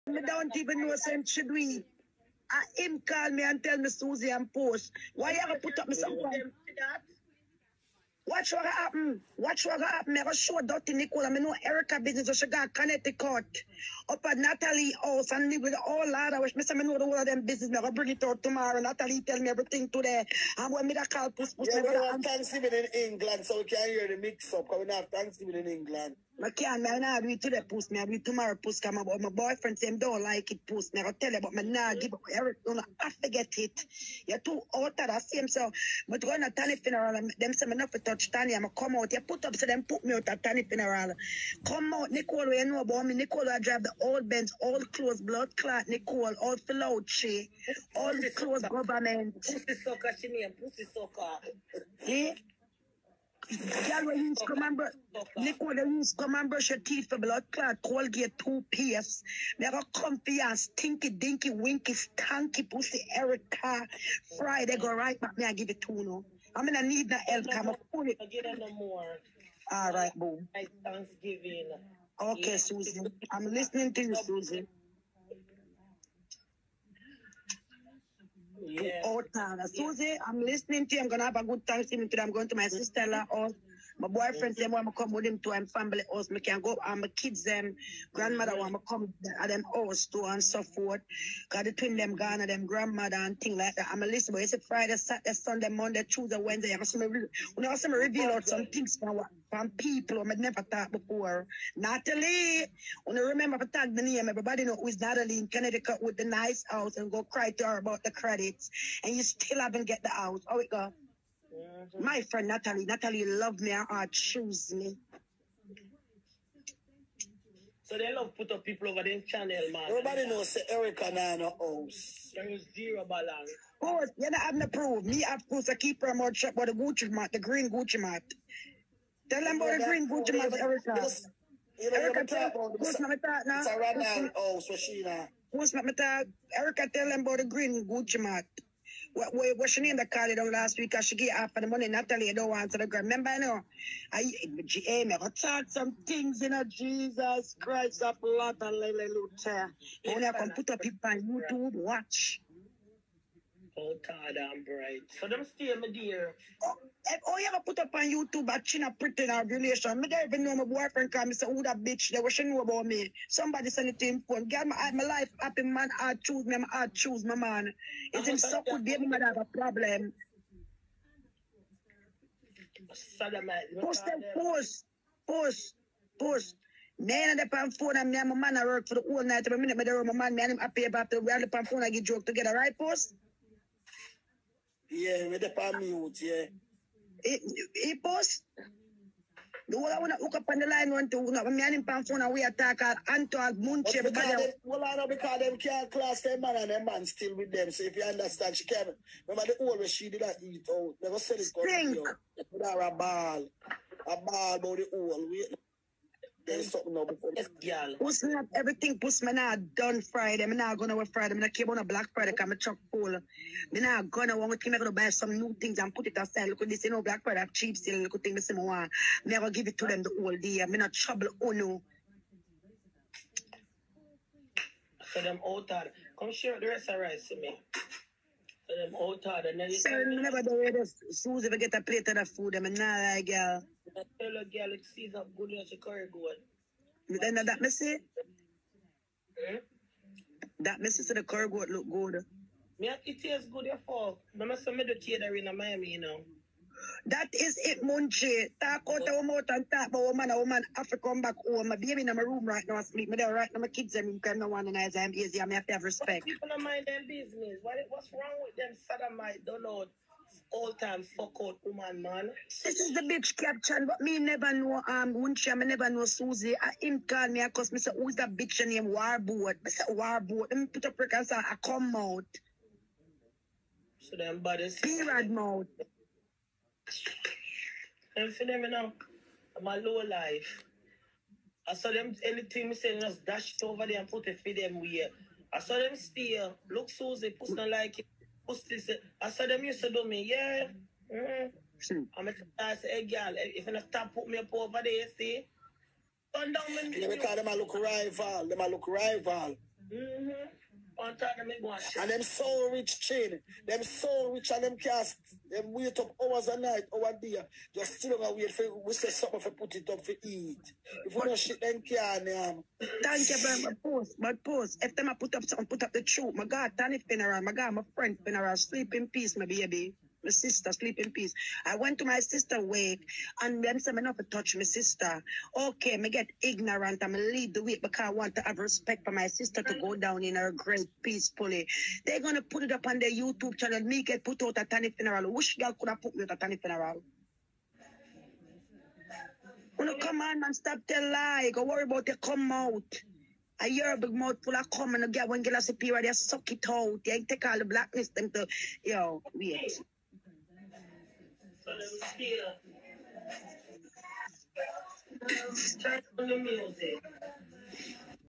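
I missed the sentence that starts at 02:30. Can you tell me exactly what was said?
Only I can put up it on YouTube, watch.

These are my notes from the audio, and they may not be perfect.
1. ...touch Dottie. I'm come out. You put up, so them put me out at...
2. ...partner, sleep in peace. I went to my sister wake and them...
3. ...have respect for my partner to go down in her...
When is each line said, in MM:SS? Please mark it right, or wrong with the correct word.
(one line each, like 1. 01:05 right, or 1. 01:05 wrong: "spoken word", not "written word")
1. 00:37 wrong: "Tani", not "Dottie"
2. 05:20 wrong: "sister", not "partner"
3. 05:28 wrong: "sister", not "partner".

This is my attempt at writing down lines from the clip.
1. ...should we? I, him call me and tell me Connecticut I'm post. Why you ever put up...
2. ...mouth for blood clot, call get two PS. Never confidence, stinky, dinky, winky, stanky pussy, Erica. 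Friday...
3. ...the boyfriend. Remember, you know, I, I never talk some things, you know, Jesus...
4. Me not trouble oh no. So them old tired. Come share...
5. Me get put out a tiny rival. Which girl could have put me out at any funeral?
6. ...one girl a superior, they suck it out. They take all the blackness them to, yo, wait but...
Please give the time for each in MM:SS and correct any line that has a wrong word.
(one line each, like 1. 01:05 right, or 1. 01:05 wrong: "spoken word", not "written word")
1. 00:01 wrong: "Susie", not "Connecticut"
2. 00:56 wrong: "teeth", not "mouth"
3. 02:22 wrong: "ground", not "boyfriend"
4. 03:40 right
5. 05:33 wrong: "funeral", not "rival"
6. 05:45 right.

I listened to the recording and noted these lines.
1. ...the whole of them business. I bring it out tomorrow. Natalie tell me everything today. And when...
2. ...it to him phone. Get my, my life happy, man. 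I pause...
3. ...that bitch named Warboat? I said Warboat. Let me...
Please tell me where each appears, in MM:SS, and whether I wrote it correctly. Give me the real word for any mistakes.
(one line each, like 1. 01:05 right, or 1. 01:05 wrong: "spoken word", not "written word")
1. 00:16 right
2. 02:43 wrong: "choose", not "pause"
3. 04:28 right.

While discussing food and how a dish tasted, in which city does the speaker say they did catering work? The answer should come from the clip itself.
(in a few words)
Miami.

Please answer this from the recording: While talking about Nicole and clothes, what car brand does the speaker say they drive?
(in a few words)
Benz.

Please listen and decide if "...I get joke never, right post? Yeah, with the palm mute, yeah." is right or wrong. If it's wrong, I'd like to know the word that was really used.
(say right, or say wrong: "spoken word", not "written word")
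wrong: "together", not "never".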